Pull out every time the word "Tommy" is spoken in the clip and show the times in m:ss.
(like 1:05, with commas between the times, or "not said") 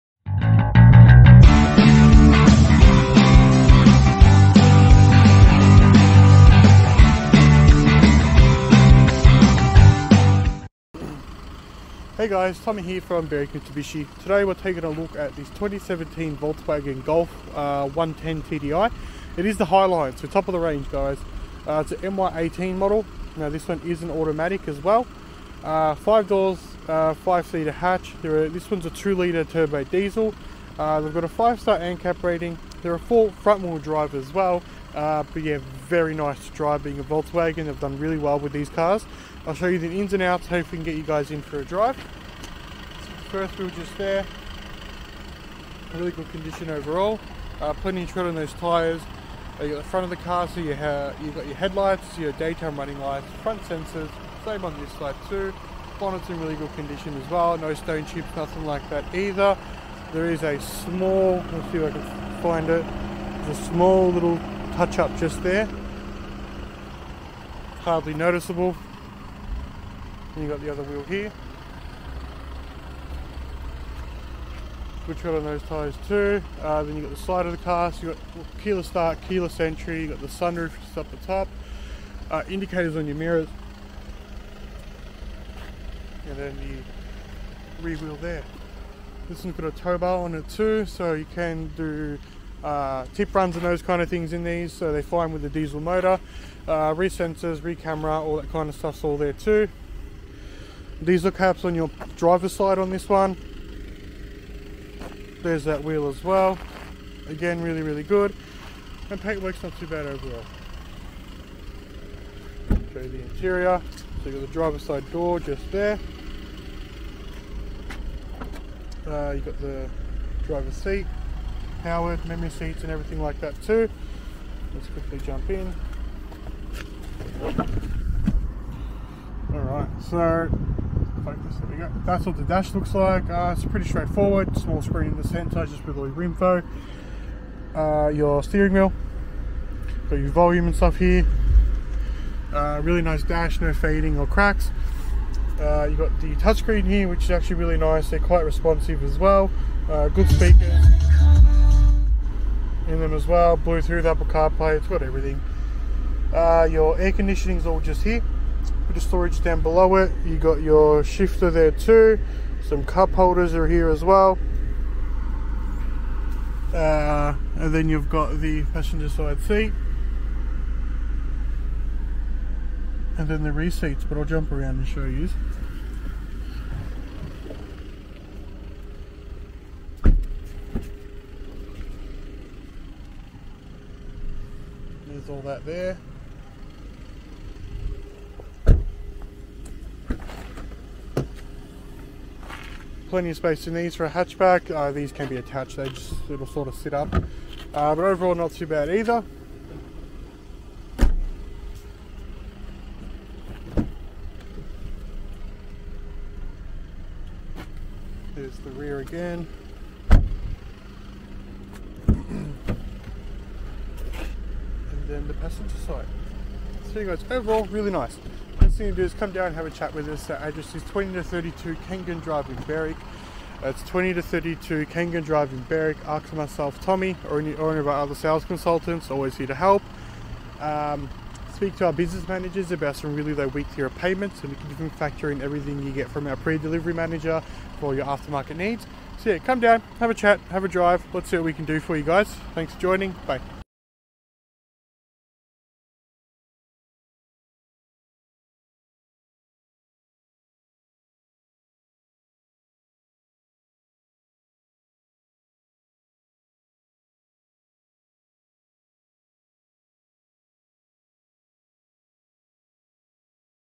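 0:12, 3:46.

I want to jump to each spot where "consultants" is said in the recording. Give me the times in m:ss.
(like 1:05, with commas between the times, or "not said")
3:48.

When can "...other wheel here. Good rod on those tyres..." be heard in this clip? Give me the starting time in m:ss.
1:10.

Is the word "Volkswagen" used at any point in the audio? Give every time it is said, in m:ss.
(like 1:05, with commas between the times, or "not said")
0:16, 0:37.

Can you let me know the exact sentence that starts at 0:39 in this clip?
I'll show you the ins and outs, hopefully can get you guys in for a drive.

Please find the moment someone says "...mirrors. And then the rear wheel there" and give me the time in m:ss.
1:23.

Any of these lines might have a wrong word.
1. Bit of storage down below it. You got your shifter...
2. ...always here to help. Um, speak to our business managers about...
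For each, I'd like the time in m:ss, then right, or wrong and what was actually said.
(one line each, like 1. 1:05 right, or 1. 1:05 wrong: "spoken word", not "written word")
1. 2:38 right
2. 3:49 right.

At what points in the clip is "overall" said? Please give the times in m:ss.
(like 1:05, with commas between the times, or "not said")
0:46, 1:50, 3:18, 3:37.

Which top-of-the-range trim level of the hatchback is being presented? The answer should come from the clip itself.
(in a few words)
Highline.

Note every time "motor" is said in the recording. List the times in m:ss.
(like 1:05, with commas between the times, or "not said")
1:35.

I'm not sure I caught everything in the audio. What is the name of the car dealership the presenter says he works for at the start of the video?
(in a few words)
Berwick Mitsubishi.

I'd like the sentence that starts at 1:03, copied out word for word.
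There's a small little touch up just there.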